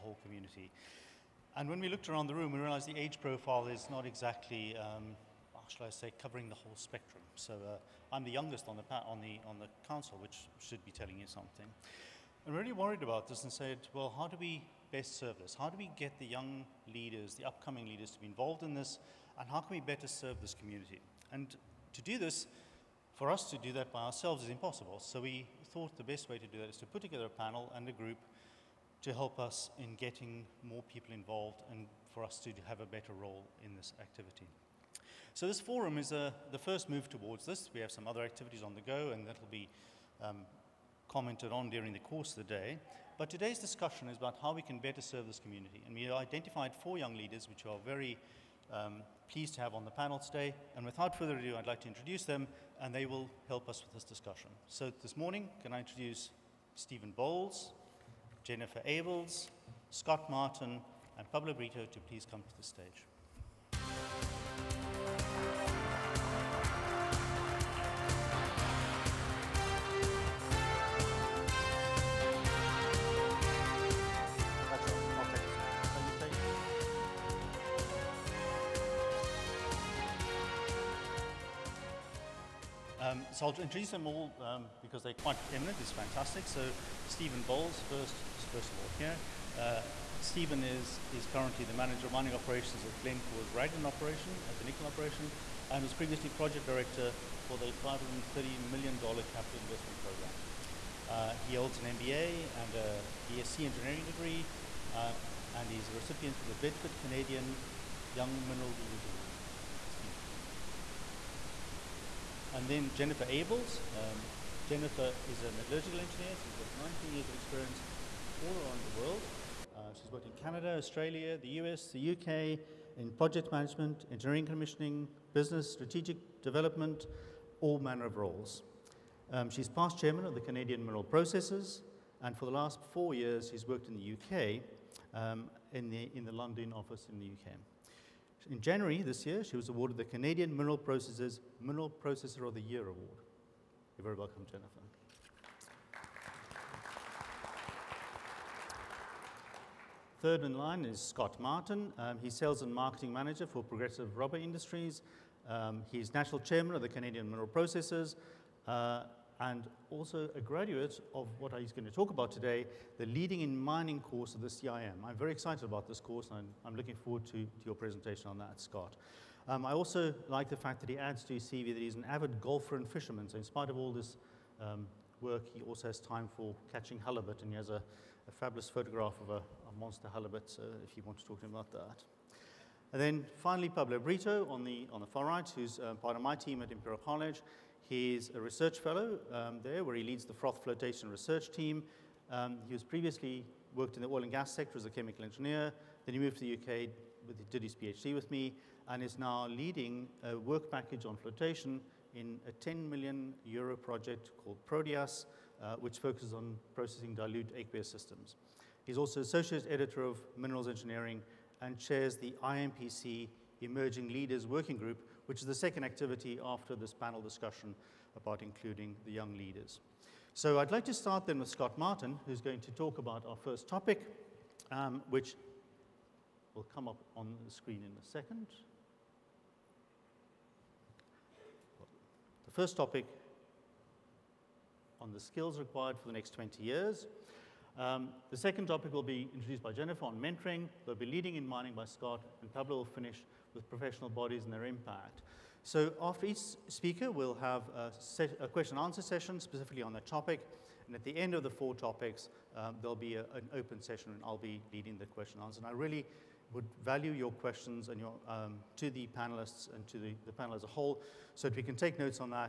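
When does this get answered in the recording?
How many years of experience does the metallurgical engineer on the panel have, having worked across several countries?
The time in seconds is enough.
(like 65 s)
116 s.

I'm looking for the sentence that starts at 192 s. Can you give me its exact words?
Um, he was previously worked in the oil and gas sector as a chemical engineer.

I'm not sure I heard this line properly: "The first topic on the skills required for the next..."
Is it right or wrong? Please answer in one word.
right.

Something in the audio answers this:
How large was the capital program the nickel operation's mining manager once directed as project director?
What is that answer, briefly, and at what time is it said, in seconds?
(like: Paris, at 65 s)
$530 million, at 97 s.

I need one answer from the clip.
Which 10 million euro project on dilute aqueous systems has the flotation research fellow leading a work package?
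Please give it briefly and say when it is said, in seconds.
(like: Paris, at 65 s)
Proteas, at 204 s.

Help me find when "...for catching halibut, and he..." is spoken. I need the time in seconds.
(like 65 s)
176 s.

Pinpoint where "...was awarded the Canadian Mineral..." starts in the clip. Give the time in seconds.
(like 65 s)
139 s.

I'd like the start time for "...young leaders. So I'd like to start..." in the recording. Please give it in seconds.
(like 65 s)
219 s.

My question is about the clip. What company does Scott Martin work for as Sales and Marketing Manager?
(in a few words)
Progressive Rubber Industries.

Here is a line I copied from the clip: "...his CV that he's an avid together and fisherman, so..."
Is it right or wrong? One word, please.
wrong.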